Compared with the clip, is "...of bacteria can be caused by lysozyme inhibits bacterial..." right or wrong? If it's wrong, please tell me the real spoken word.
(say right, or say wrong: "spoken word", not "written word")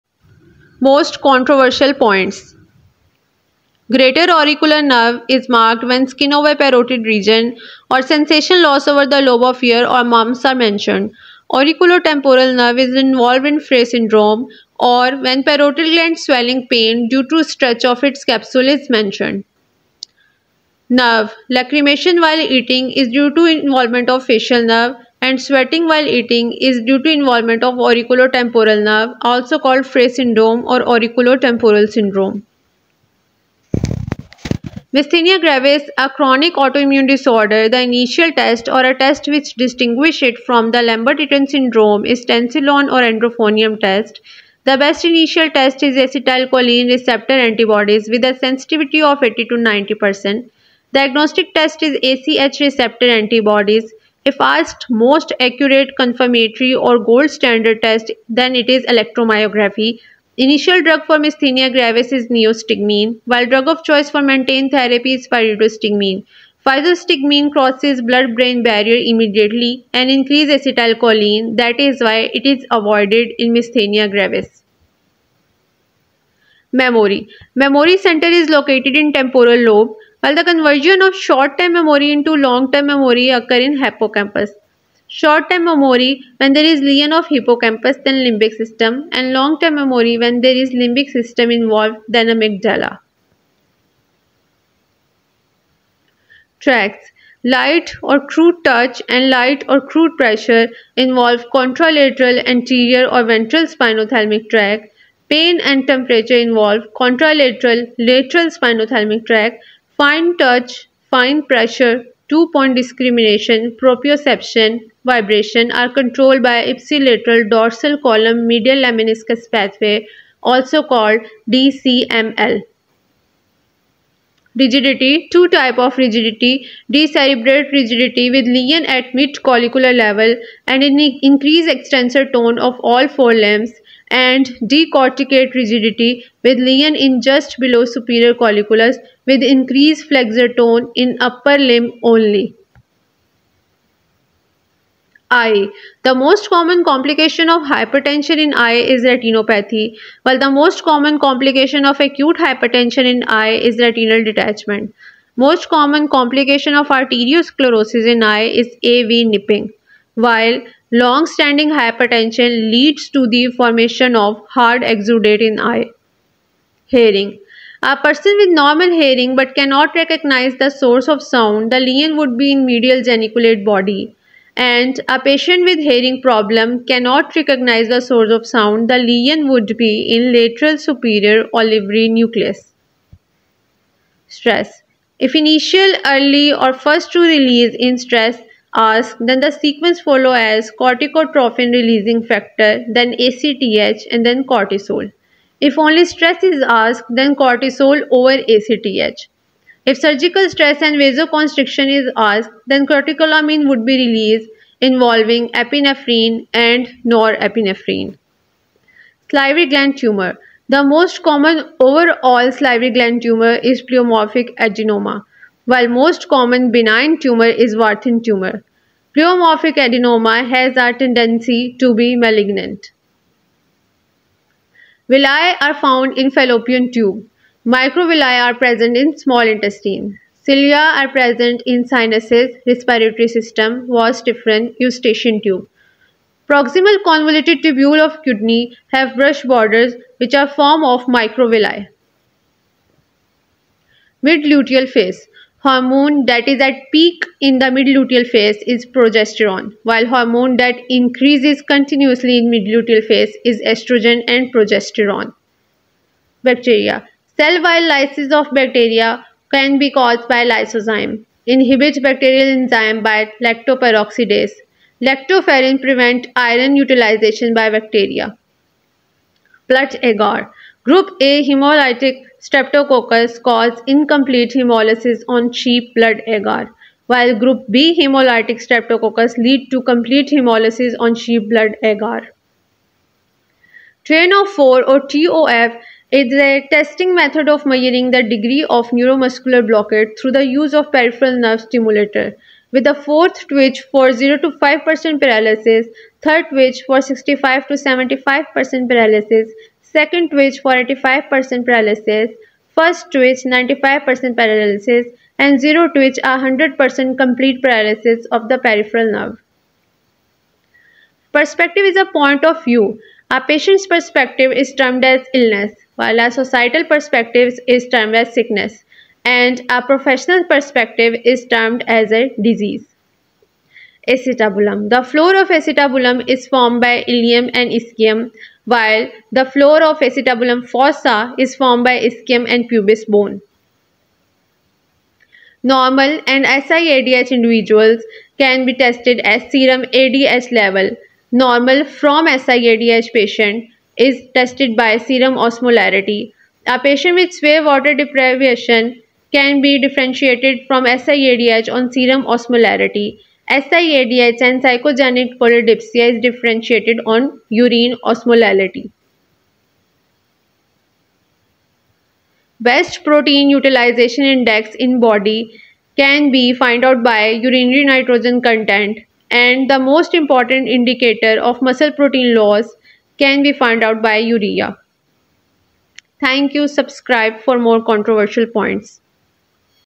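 right.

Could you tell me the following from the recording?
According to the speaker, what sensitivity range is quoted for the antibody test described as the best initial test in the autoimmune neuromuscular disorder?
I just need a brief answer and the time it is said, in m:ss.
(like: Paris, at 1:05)
80 to 90%, at 0:49.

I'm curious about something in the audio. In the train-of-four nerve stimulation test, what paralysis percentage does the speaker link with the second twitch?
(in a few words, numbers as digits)
85%.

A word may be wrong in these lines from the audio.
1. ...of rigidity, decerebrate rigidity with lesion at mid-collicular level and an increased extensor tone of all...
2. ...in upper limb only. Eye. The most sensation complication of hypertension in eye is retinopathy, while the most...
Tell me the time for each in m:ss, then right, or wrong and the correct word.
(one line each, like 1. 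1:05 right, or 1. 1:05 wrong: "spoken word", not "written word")
1. 2:05 right
2. 2:20 wrong: "common", not "sensation".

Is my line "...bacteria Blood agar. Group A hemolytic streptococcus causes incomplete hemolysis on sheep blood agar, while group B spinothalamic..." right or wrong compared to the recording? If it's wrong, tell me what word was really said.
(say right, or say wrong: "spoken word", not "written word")
wrong: "hemolytic", not "spinothalamic".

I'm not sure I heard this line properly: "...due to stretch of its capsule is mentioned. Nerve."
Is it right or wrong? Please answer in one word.
right.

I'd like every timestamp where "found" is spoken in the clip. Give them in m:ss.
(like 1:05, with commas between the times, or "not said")
3:45, 6:06, 6:13.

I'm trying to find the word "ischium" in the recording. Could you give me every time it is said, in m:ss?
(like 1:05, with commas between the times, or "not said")
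5:27, 5:31.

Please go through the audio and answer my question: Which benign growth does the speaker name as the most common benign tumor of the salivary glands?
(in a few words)
Warthin tumor.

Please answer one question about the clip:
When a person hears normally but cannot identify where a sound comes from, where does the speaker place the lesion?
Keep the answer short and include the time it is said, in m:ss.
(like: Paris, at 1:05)
medial geniculate body, at 2:52.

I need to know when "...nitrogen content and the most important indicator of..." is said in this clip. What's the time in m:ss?
6:07.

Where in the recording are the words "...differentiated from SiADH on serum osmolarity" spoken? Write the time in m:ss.
5:49.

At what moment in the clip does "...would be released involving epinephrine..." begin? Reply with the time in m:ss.
3:23.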